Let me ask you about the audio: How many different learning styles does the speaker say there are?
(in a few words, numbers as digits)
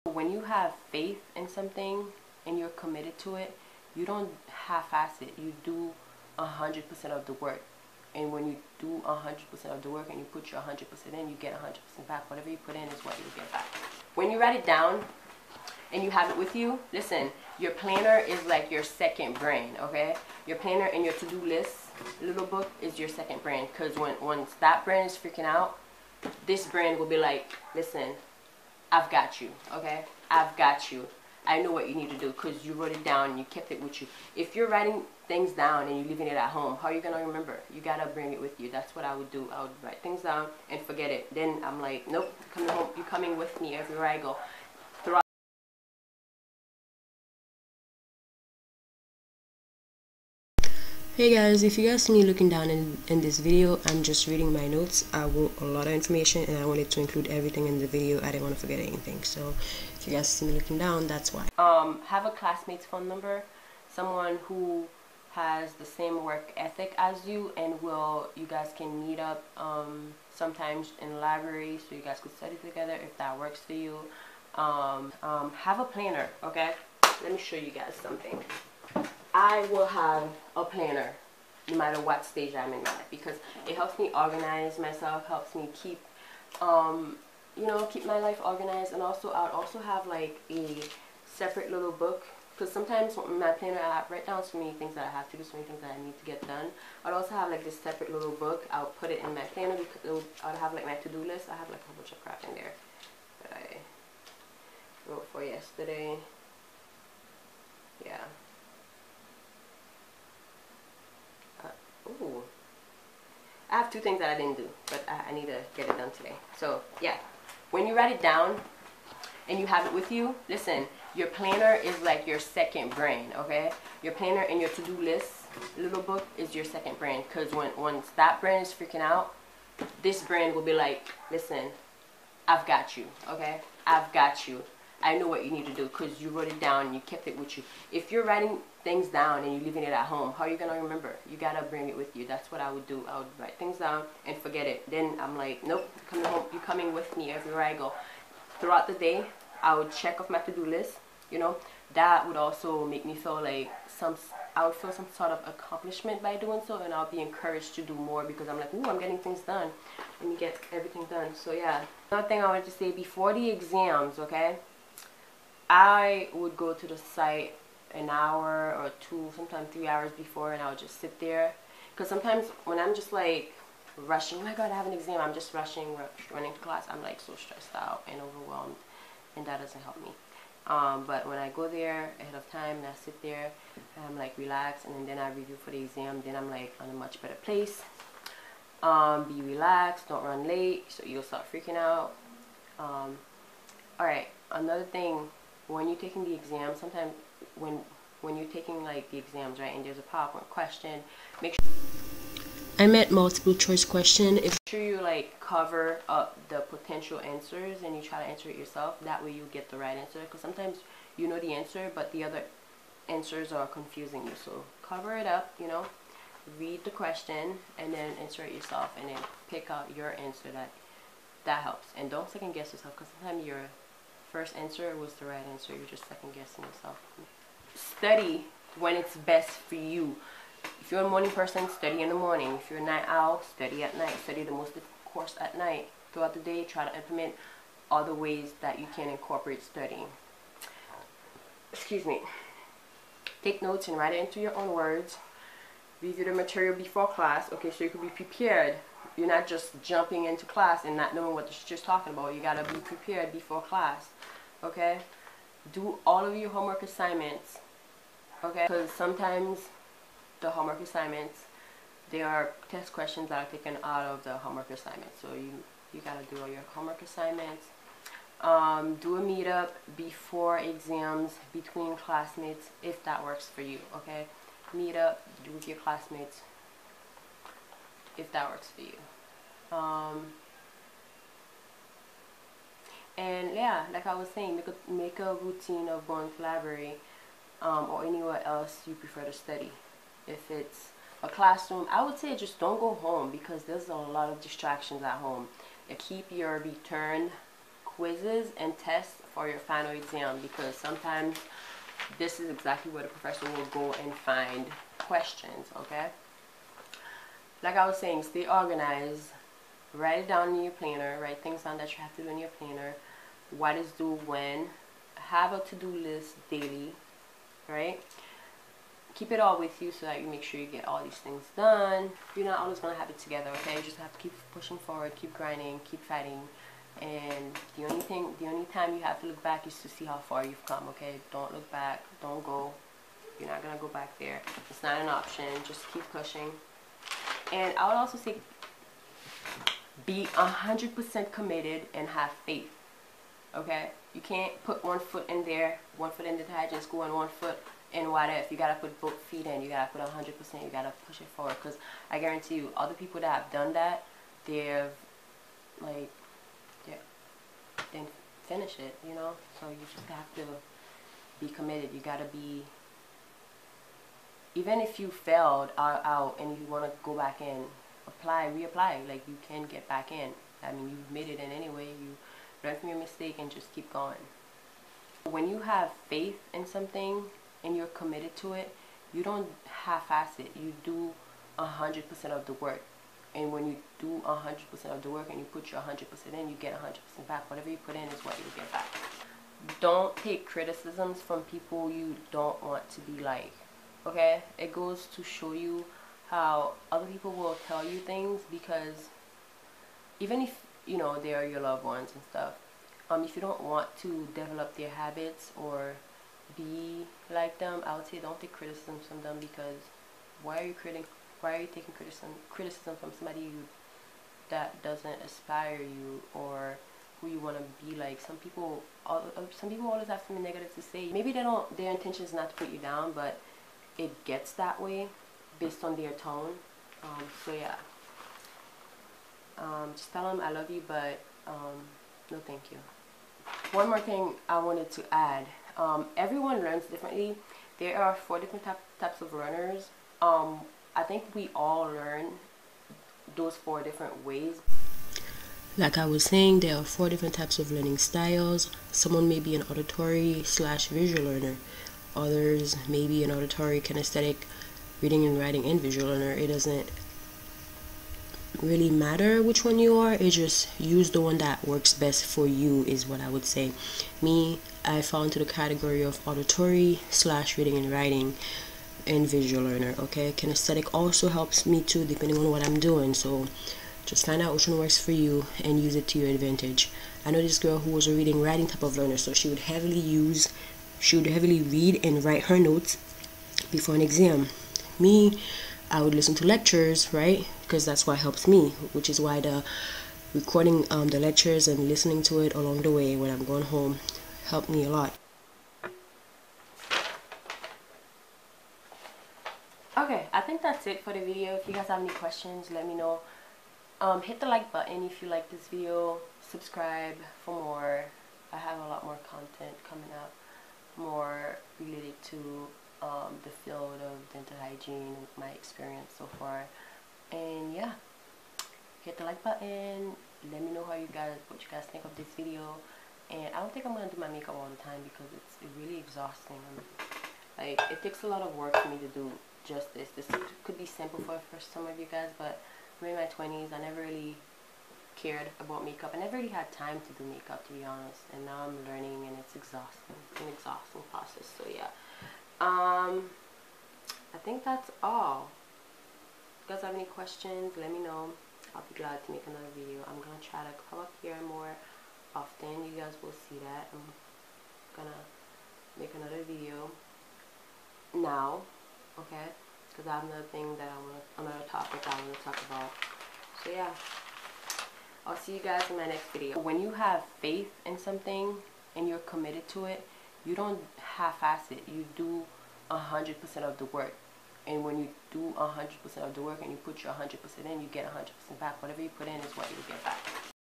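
4.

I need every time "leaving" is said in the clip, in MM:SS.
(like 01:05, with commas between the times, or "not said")
00:36, 02:19.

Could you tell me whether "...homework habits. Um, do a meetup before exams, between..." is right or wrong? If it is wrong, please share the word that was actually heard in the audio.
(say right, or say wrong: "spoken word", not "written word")
wrong: "assignments", not "habits".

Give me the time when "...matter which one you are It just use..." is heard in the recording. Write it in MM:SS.
07:38.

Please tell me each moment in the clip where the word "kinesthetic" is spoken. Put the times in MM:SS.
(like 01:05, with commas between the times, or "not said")
07:33, 07:50.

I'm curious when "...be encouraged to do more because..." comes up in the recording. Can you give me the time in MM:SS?
02:37.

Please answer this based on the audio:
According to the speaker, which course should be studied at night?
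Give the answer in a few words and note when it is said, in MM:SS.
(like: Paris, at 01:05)
the most difficult course, at 03:54.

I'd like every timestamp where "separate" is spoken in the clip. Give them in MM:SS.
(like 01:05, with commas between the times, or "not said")
01:31, 01:37.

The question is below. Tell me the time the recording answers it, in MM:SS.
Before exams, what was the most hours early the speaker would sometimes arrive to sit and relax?
02:49.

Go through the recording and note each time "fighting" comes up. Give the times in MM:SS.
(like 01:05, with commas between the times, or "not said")
05:26.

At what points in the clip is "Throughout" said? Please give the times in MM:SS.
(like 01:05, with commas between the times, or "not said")
02:28, 03:56.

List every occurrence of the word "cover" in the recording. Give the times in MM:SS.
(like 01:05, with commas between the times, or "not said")
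03:25, 03:34.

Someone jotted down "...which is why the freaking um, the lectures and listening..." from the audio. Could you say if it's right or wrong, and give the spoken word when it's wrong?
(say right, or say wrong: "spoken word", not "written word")
wrong: "recording", not "freaking".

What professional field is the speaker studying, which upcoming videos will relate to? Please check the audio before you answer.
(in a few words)
dental hygiene.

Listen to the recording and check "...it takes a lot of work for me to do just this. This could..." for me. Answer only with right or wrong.
right.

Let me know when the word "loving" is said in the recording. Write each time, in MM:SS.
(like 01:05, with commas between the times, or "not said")
not said.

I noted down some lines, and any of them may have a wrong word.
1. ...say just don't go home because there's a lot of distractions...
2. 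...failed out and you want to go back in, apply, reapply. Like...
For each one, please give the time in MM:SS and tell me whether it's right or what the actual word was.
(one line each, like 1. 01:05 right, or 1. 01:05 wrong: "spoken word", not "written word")
1. 04:52 right
2. 06:05 right.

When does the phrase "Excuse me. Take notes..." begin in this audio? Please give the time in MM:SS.
04:01.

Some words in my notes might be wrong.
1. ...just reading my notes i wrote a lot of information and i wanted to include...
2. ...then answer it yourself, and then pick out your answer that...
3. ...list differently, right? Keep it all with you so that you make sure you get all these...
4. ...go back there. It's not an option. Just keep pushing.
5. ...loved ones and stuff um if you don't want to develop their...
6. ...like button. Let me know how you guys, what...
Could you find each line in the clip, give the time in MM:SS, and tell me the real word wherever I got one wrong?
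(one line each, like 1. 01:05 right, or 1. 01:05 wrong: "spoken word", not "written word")
1. 00:54 right
2. 03:37 right
3. 05:15 wrong: "daily", not "differently"
4. 05:33 right
5. 06:41 right
6. 08:39 right.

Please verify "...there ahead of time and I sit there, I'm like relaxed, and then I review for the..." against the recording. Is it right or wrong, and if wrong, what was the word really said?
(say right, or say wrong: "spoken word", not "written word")
right.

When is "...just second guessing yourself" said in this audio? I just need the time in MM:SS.
03:45.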